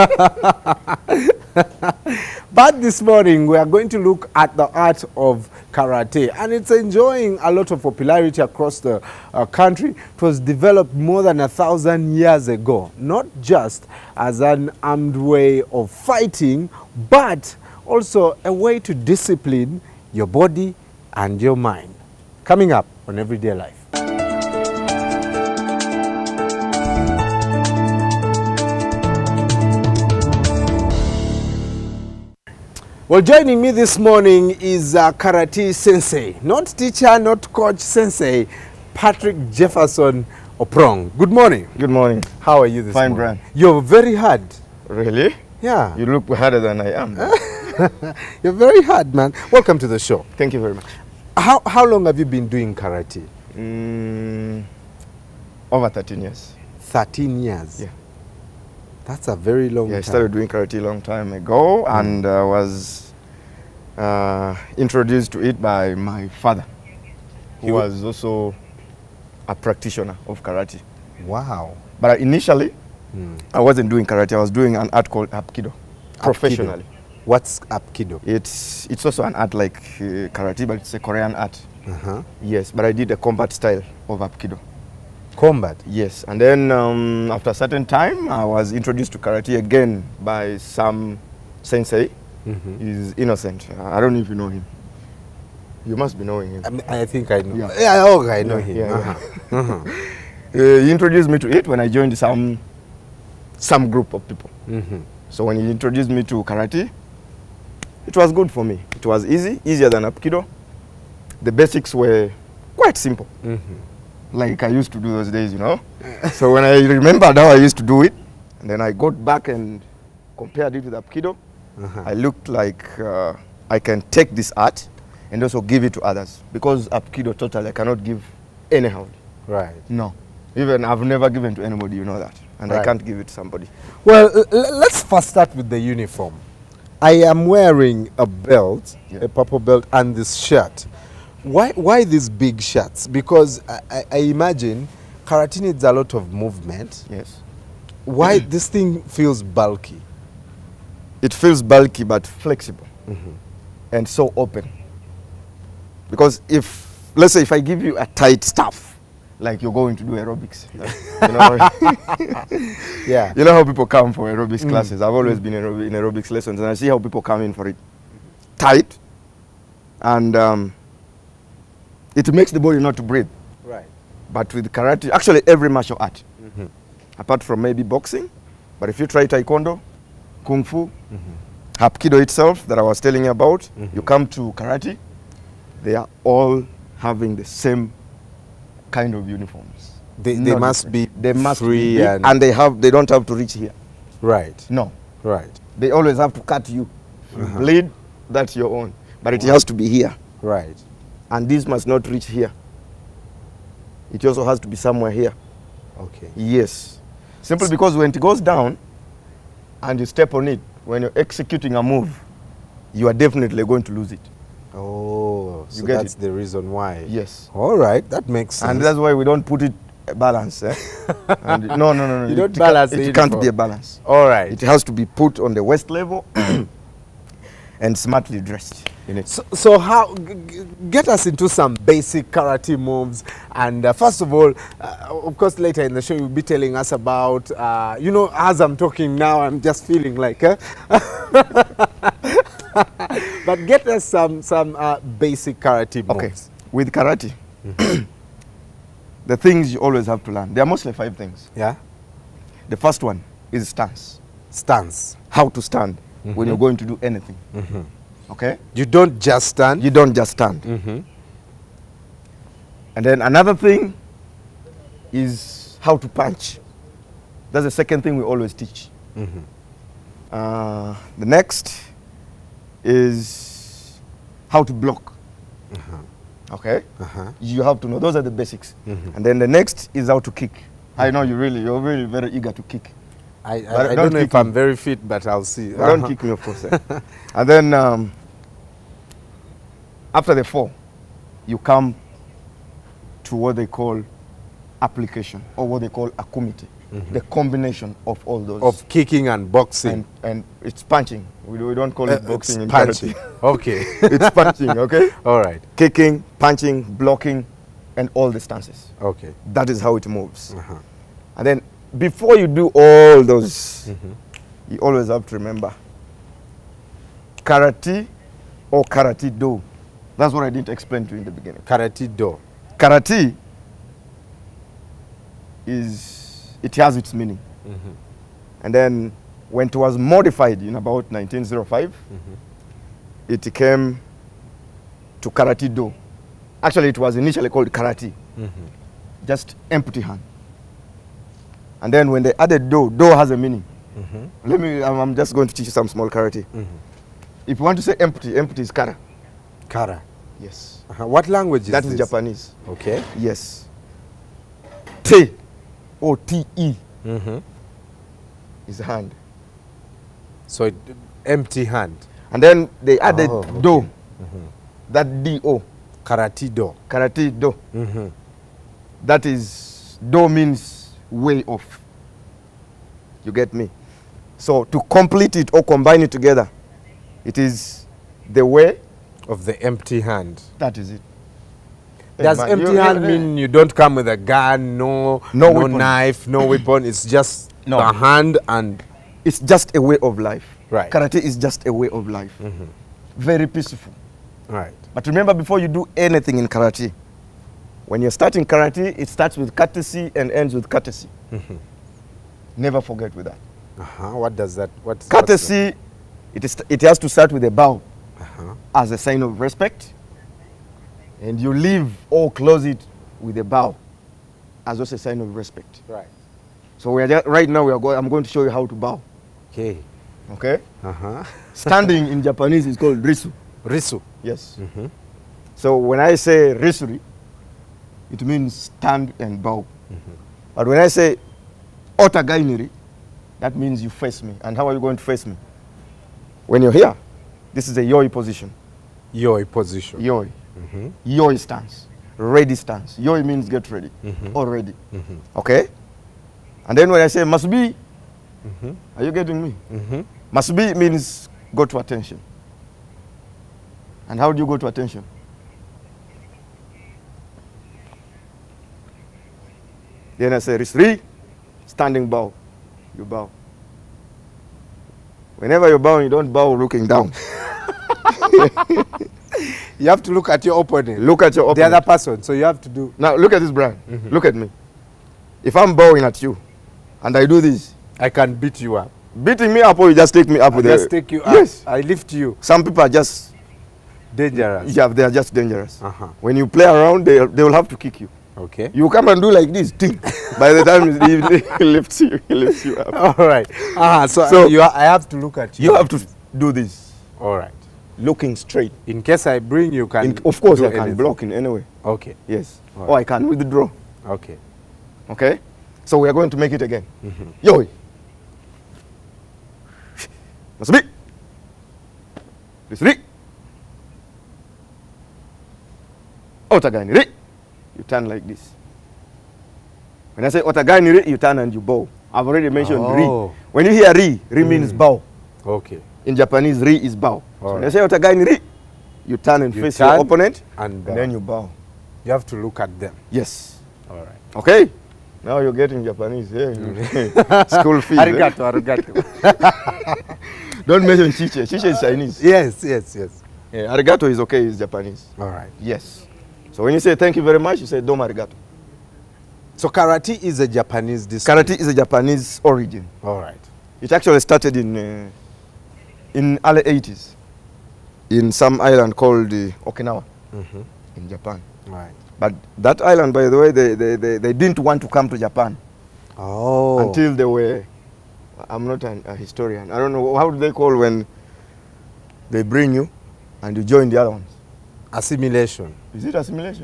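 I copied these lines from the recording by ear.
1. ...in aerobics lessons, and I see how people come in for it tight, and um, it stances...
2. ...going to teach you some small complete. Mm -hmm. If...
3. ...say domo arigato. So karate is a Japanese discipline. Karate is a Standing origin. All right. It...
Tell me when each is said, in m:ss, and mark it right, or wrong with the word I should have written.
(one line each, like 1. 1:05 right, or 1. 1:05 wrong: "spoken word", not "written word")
1. 2:45 wrong: "makes", not "stances"
2. 5:45 wrong: "karate", not "complete"
3. 9:07 wrong: "Japanese", not "Standing".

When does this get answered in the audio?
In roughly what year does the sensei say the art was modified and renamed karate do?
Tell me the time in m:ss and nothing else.
5:31.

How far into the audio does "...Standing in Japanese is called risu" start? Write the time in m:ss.
7:01.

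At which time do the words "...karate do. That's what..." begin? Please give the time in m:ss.
5:18.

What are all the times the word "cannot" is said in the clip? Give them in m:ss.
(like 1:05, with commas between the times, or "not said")
2:07.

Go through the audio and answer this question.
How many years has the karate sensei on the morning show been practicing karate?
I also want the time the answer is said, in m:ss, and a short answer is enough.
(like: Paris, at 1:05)
Over 13 years, at 0:55.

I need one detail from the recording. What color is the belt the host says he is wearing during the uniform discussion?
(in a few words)
Purple.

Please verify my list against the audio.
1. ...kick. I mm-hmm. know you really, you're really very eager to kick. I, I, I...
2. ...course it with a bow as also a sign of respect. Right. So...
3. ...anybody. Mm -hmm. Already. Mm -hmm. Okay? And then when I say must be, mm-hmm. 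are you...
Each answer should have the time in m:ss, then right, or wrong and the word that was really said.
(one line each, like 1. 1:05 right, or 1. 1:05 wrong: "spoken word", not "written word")
1. 4:40 right
2. 6:52 wrong: "close", not "course"
3. 7:23 wrong: "ready", not "anybody".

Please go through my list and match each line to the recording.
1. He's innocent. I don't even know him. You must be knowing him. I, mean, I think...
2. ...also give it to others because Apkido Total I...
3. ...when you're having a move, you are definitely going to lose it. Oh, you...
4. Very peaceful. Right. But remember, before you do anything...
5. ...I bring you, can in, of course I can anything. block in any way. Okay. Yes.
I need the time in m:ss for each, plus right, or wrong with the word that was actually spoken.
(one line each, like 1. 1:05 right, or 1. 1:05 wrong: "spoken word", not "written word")
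1. 1:33 right
2. 2:05 right
3. 3:30 wrong: "executing", not "having"
4. 6:33 right
5. 8:19 right.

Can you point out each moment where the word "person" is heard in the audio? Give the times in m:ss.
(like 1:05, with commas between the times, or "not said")
7:51.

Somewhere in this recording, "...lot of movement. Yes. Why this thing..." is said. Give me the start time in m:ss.
2:25.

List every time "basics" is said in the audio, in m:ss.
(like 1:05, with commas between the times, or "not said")
1:51, 3:51, 4:05, 4:38.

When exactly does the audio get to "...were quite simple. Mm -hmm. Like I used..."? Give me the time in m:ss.
1:51.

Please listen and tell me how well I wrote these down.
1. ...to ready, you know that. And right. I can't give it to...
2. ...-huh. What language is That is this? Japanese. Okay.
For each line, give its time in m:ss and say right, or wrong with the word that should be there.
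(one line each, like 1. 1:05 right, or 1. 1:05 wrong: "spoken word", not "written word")
1. 2:11 wrong: "anybody", not "ready"
2. 5:50 right.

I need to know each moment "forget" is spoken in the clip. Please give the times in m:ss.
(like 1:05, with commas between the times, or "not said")
6:42.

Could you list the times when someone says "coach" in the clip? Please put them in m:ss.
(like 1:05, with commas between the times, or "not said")
0:37.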